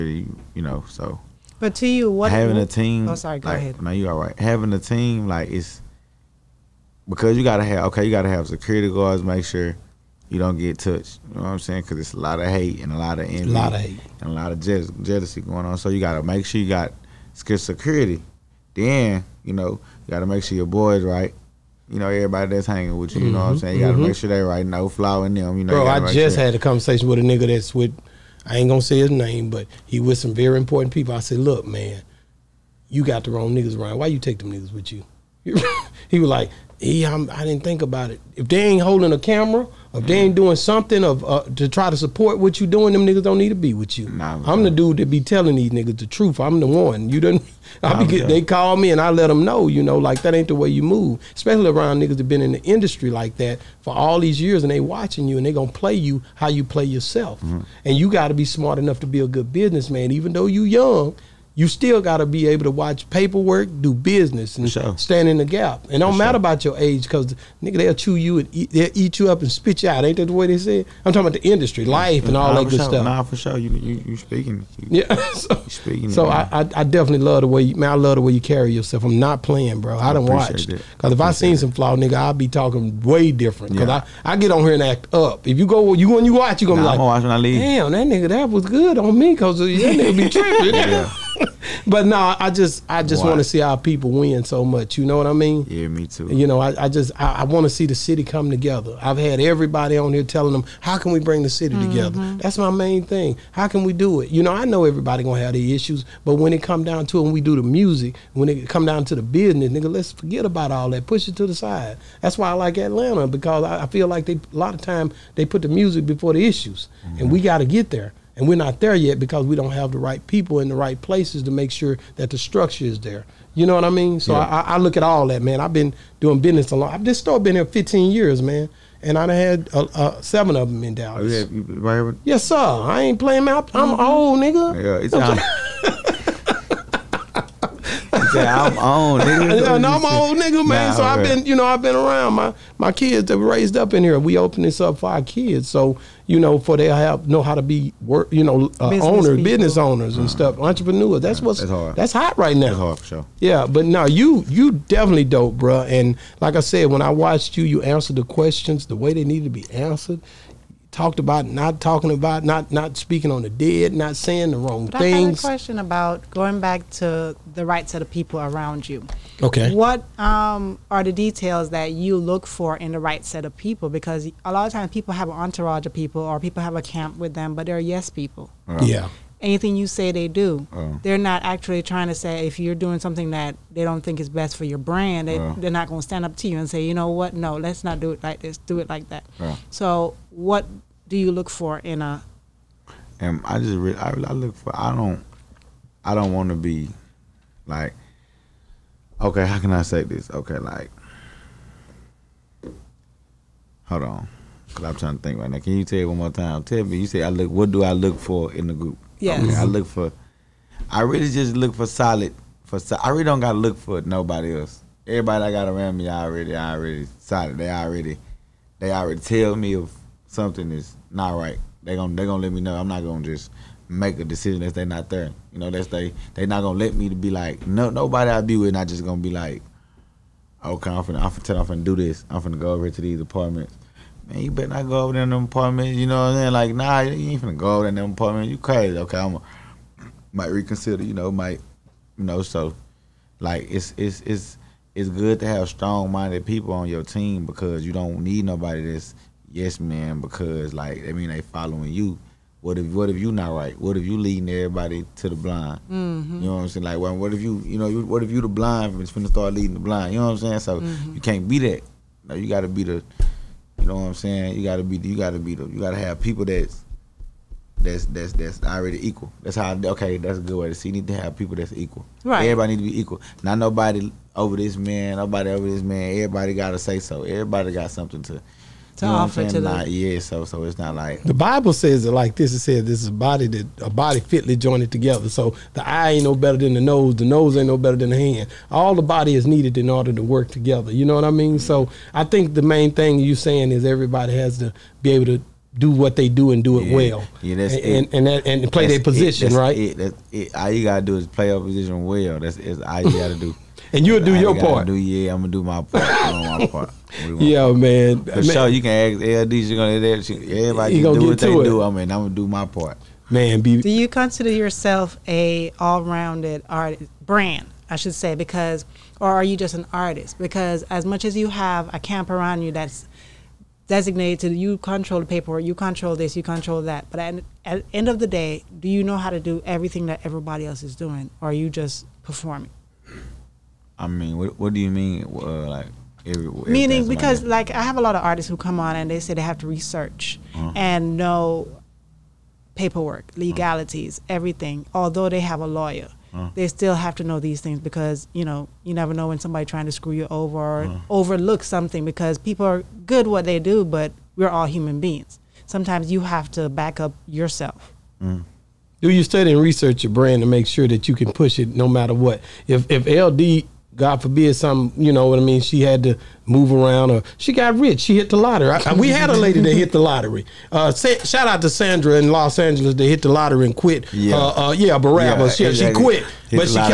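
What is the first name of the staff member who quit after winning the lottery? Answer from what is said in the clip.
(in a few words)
Sandra.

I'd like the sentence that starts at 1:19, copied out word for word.
I, I don't watch because if I seen it.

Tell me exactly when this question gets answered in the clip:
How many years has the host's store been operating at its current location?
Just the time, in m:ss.
2:07.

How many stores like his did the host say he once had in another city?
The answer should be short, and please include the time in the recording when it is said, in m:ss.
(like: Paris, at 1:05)
7, at 2:10.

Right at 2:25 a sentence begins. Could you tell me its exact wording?
So, you know, for they have know how to be work, you know, uh, business owners, people.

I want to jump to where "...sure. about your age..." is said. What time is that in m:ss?
1:06.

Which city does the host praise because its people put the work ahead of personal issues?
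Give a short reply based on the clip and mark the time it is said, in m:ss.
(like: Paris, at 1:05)
Atlanta, at 1:52.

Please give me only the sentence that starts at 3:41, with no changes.
They gonna they gonna let me know.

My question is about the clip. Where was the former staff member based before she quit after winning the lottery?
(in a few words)
Los Angeles.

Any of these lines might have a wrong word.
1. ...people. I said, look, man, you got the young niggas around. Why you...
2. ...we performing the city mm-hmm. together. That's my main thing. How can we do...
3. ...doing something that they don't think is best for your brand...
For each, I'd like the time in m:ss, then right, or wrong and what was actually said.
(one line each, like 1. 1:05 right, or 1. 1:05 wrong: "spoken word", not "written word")
1. 0:30 wrong: "wrong", not "young"
2. 1:41 wrong: "bring", not "performing"
3. 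3:02 right.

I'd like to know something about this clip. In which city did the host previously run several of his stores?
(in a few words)
Dallas.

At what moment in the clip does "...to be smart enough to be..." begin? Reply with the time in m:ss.
0:58.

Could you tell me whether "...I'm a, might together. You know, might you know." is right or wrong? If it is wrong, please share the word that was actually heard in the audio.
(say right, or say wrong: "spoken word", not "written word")
wrong: "reconsider", not "together".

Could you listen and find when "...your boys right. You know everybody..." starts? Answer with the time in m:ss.
0:20.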